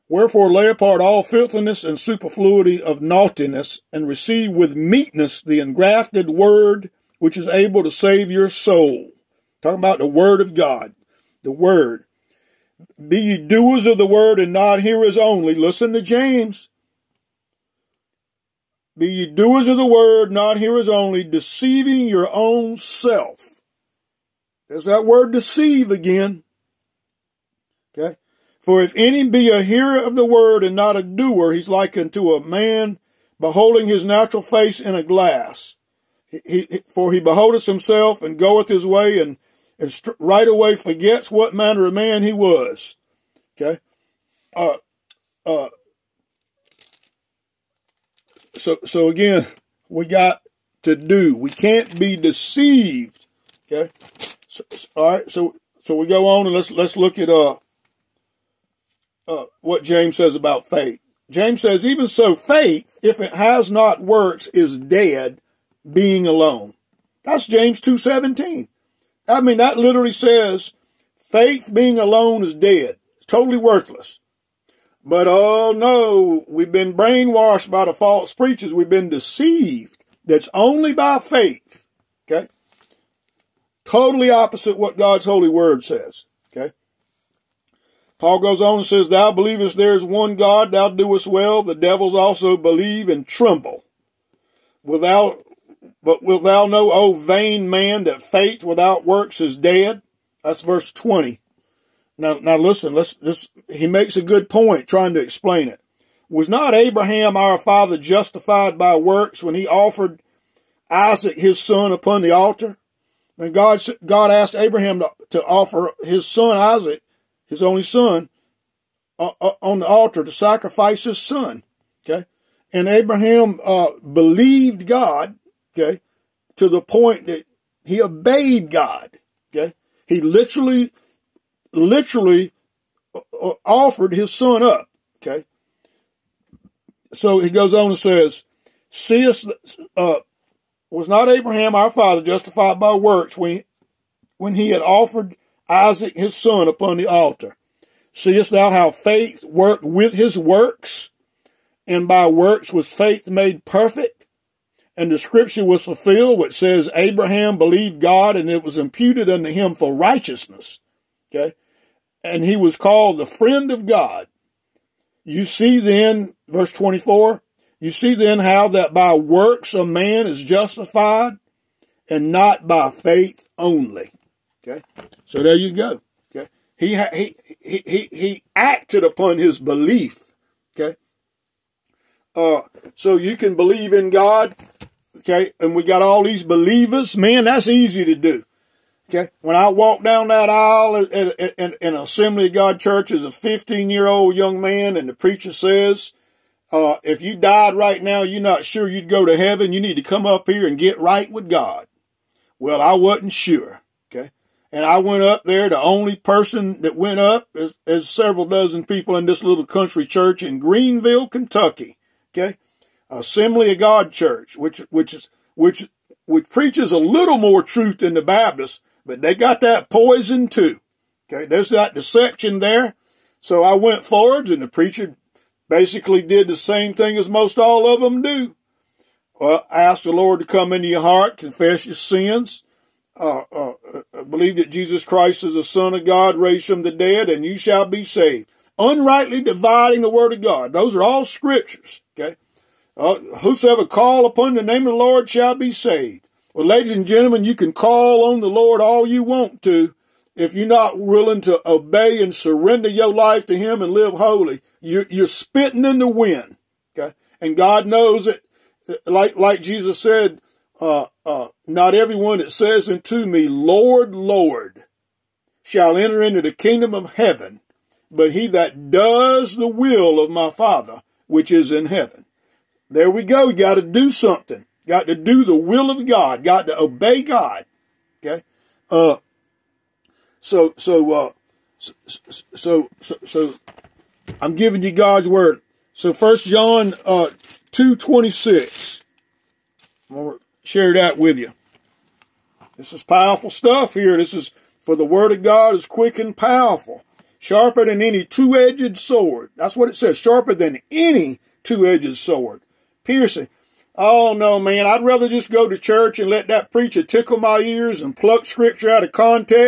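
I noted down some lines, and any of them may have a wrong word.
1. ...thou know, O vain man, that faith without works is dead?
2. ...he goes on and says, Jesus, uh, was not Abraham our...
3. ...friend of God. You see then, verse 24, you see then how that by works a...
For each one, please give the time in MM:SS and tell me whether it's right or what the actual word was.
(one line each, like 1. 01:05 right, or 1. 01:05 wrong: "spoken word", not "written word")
1. 01:36 right
2. 02:17 wrong: "Seest", not "Jesus"
3. 02:43 right.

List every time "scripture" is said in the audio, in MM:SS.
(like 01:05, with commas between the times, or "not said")
02:35, 04:01, 05:08.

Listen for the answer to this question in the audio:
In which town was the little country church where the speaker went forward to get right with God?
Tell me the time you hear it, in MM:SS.
03:30.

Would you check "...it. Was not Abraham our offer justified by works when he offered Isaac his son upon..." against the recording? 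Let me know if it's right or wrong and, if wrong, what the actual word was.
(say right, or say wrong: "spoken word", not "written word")
wrong: "father", not "offer".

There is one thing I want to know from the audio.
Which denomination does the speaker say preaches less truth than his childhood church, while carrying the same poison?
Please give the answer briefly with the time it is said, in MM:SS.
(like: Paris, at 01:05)
Baptists, at 03:38.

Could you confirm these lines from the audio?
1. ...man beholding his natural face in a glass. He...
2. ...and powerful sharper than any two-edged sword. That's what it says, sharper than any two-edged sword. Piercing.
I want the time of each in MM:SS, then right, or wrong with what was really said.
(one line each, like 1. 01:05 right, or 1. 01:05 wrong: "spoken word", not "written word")
1. 00:32 right
2. 04:56 right.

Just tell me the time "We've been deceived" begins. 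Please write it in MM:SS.
01:18.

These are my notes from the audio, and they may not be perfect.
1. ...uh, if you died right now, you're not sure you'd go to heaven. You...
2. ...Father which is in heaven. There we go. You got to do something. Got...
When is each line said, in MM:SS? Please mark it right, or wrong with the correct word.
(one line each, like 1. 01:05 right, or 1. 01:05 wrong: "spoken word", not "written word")
1. 03:16 right
2. 04:30 right.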